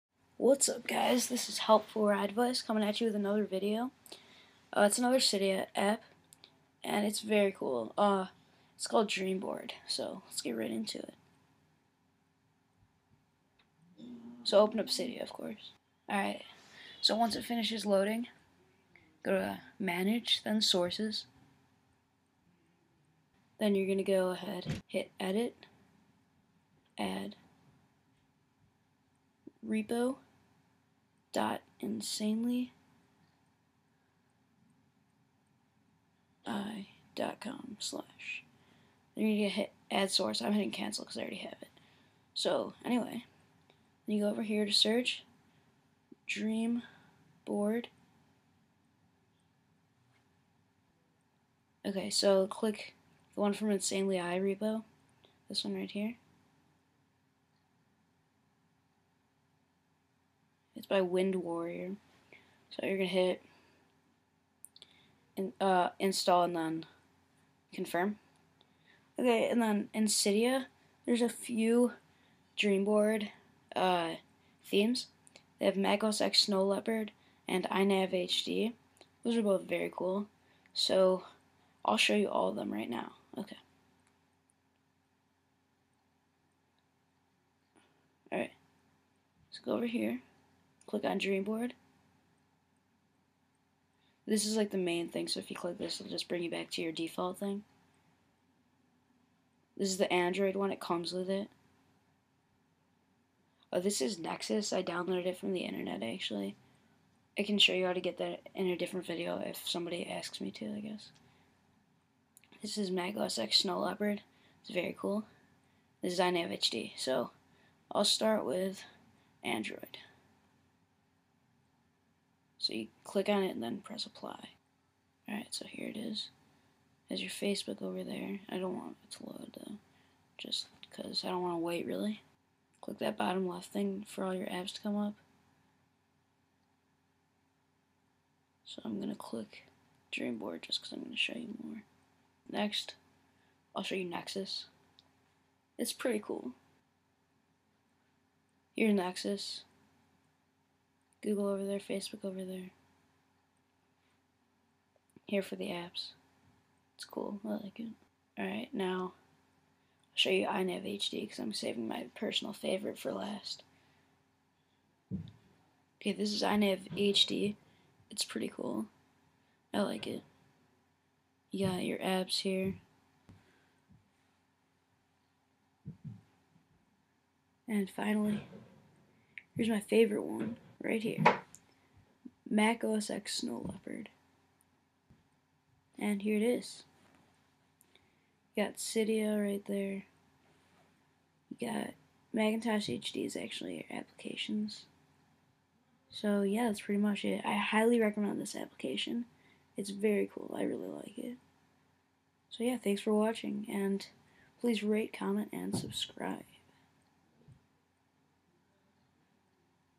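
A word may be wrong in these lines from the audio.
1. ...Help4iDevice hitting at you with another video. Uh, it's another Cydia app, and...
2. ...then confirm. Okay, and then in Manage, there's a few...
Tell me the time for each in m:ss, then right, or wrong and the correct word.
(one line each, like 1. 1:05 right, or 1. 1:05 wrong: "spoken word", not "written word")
1. 0:01 wrong: "coming", not "hitting"
2. 1:06 wrong: "Cydia", not "Manage".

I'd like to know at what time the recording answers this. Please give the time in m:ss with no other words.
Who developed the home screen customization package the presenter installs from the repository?
1:01.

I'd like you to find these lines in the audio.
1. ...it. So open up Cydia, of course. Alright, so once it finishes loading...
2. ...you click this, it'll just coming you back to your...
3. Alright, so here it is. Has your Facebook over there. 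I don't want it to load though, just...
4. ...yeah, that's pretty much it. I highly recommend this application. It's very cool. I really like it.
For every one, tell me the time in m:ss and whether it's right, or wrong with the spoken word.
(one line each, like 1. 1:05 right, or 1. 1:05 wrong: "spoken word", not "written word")
1. 0:10 right
2. 1:35 wrong: "bring", not "coming"
3. 2:05 right
4. 3:16 right.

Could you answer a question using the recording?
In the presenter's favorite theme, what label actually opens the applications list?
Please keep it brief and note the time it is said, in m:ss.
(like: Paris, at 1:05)
Macintosh HD, at 3:12.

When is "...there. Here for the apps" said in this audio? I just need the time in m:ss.
2:32.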